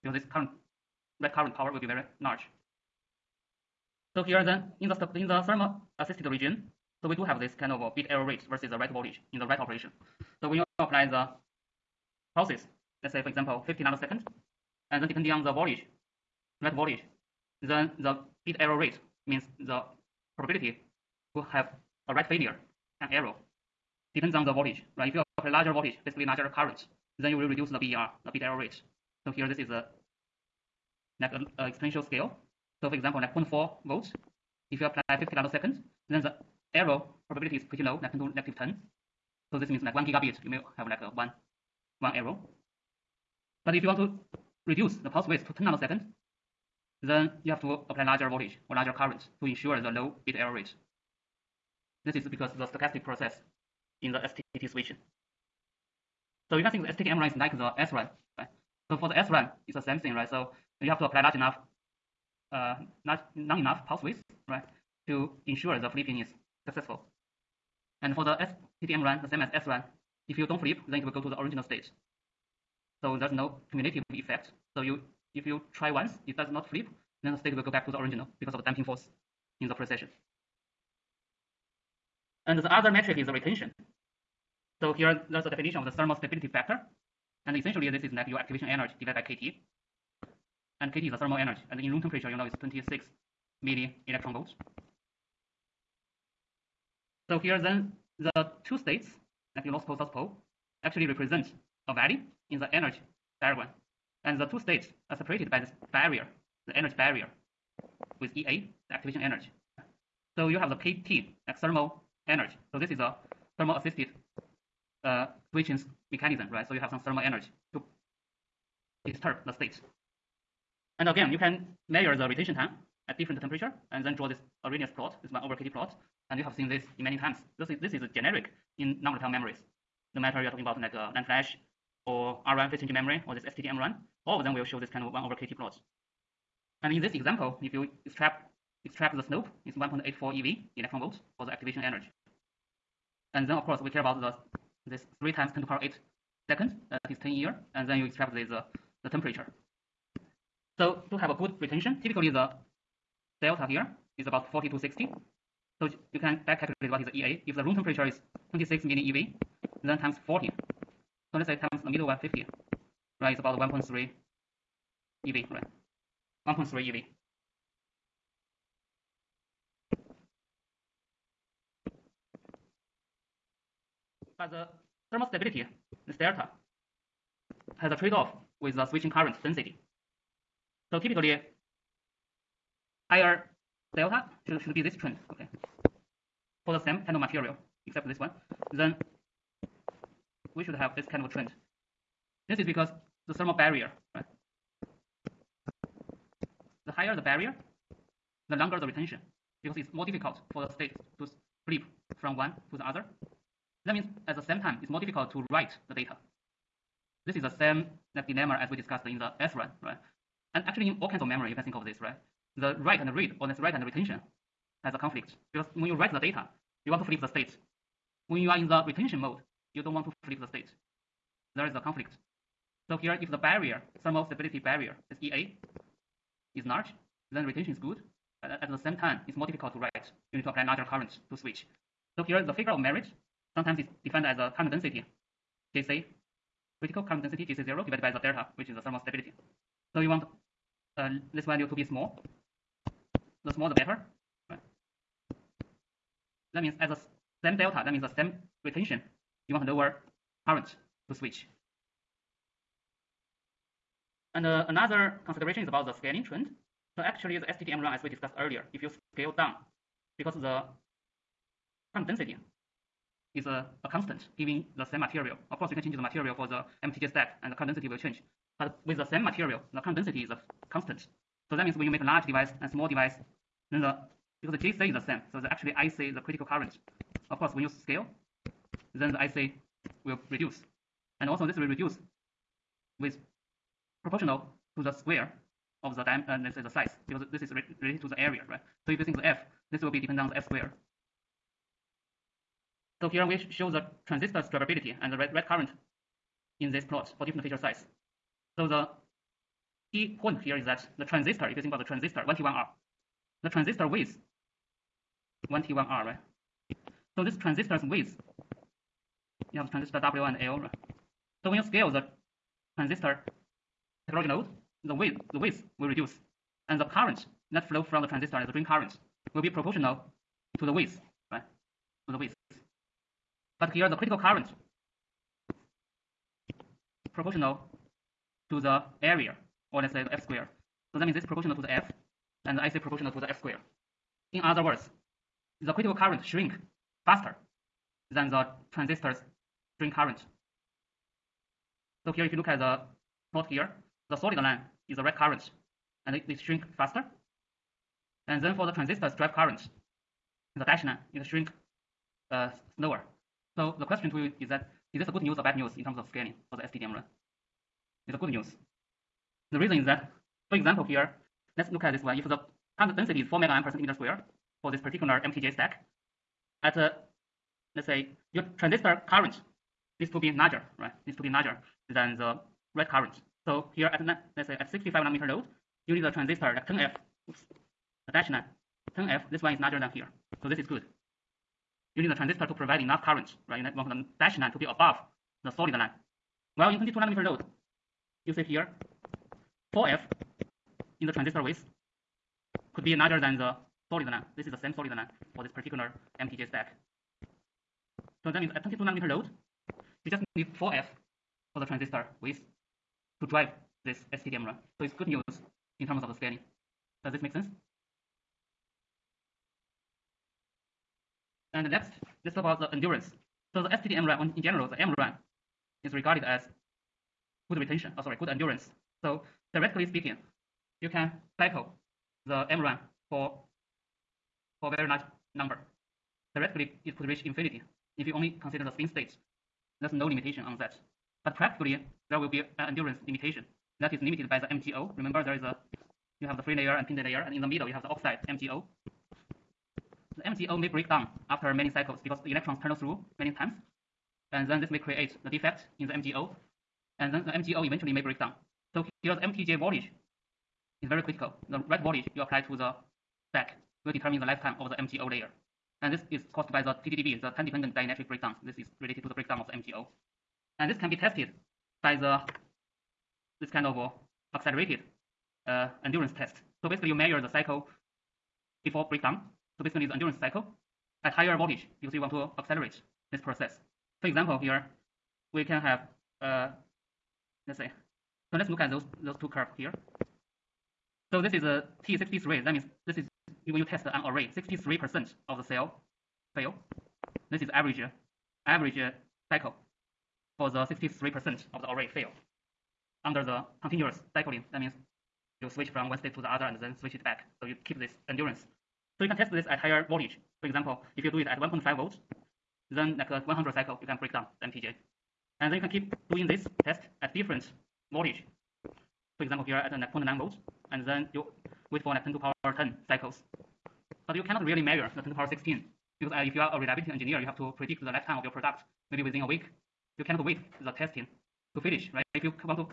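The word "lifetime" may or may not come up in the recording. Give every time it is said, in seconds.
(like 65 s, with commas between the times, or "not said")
454 s, 517 s.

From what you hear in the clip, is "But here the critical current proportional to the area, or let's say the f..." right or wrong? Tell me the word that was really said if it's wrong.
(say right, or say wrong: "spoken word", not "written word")
right.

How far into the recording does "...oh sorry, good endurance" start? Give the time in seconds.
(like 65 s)
417 s.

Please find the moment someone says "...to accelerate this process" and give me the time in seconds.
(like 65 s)
472 s.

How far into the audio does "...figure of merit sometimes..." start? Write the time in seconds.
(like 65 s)
232 s.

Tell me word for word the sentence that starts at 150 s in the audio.
So to have a good retention, typically the delta here is about 40 to 60.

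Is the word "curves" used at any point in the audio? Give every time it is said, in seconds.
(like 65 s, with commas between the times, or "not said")
479 s.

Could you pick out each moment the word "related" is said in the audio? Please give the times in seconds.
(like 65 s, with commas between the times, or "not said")
287 s, 458 s.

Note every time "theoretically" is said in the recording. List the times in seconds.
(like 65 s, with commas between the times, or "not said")
419 s, 426 s.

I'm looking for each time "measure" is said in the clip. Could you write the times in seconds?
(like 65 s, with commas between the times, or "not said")
121 s, 466 s, 514 s.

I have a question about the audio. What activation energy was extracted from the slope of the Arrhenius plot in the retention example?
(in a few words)
1.84 eV.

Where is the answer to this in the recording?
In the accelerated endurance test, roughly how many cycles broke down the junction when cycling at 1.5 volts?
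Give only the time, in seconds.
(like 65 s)
503 s.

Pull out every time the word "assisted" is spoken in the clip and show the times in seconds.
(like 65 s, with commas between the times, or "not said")
5 s, 113 s.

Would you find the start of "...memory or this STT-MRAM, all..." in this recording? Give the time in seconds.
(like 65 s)
132 s.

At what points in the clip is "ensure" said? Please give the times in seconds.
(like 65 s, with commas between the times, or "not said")
49 s, 65 s.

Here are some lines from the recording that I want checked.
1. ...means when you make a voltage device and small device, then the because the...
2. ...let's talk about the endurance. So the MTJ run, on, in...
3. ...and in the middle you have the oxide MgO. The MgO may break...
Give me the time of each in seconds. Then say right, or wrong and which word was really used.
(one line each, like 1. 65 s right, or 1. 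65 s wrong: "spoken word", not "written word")
1. 271 s wrong: "large", not "voltage"
2. 412 s wrong: "STD", not "MTJ"
3. 437 s right.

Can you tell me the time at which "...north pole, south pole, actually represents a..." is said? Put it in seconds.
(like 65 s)
99 s.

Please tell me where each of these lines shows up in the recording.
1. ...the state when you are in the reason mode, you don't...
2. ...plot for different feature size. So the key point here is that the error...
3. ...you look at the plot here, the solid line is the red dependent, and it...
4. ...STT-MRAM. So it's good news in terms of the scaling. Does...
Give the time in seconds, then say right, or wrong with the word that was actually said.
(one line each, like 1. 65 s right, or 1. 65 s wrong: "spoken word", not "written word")
1. 217 s wrong: "retention", not "reason"
2. 296 s wrong: "transistor", not "error"
3. 342 s wrong: "current", not "dependent"
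4. 404 s right.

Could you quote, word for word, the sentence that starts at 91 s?
And in room temperature, you know, it's 26 milli electron volts.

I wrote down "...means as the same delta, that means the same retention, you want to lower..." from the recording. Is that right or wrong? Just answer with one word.
right.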